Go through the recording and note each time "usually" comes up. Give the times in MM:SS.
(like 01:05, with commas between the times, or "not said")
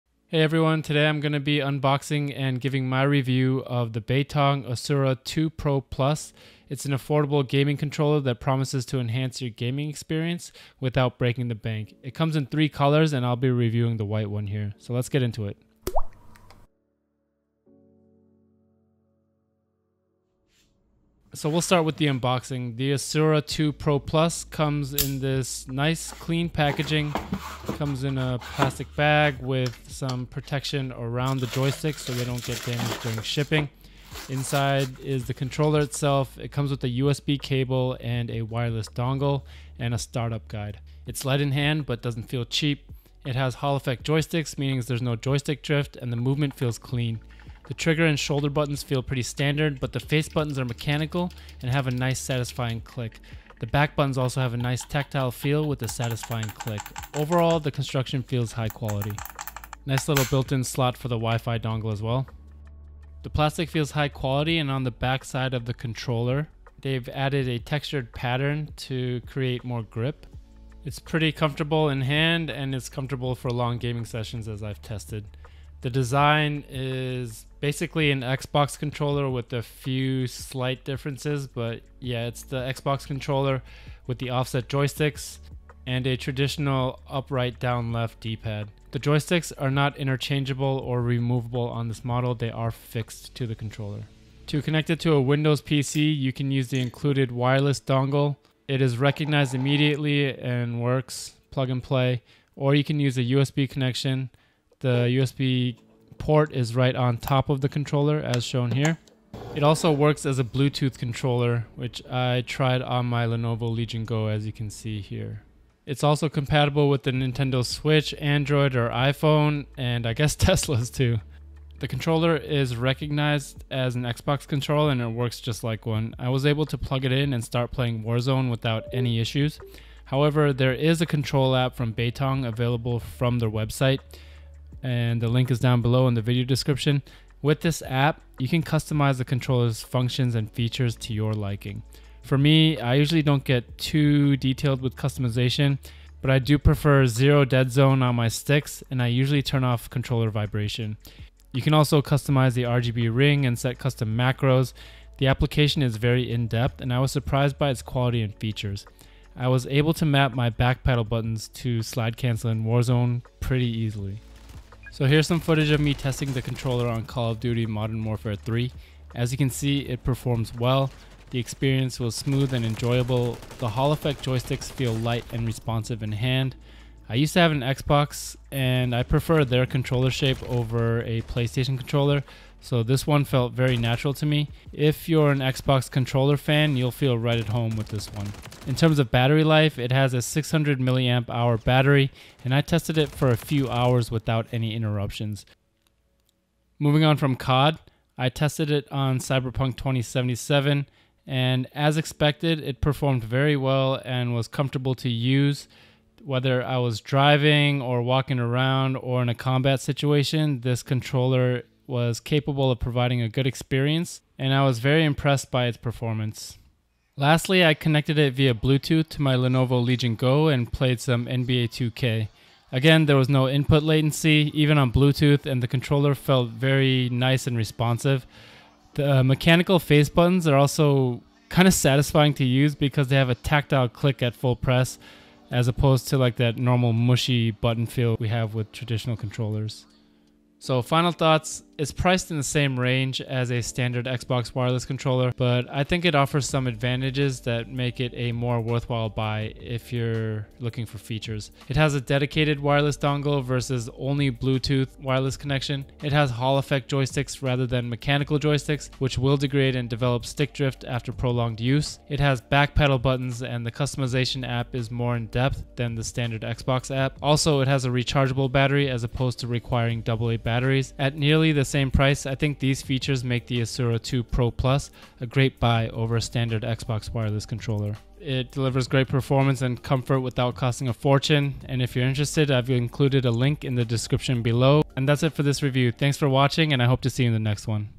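02:22, 02:29.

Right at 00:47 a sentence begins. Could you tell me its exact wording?
The trigger and shoulder buttons feel pretty standard, but the face buttons are mechanical and have a nice satisfying click.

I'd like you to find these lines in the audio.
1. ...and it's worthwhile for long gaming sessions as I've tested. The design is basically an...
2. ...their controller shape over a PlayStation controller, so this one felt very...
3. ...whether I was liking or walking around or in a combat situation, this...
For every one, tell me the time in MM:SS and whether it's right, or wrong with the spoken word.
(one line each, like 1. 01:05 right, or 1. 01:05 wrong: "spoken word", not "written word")
1. 01:12 wrong: "comfortable", not "worthwhile"
2. 02:59 right
3. 03:26 wrong: "driving", not "liking".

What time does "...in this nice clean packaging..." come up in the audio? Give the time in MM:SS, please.
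00:24.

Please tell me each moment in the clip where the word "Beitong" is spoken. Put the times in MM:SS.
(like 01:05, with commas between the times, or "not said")
00:03, 02:11.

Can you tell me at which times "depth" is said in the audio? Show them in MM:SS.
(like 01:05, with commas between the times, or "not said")
02:36, 04:25.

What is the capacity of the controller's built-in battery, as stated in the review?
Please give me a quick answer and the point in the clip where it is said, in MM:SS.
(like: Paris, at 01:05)
600 mAh, at 03:10.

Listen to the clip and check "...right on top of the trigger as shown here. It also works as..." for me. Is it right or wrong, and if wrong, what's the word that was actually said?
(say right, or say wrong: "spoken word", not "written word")
wrong: "controller", not "trigger".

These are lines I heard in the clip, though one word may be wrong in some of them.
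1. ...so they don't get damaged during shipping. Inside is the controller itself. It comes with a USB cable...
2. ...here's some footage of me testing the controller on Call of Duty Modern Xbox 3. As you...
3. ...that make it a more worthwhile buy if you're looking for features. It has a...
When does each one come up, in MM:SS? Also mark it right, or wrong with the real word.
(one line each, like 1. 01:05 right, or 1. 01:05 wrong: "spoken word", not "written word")
1. 00:31 right
2. 02:45 wrong: "Warfare", not "Xbox"
3. 04:07 right.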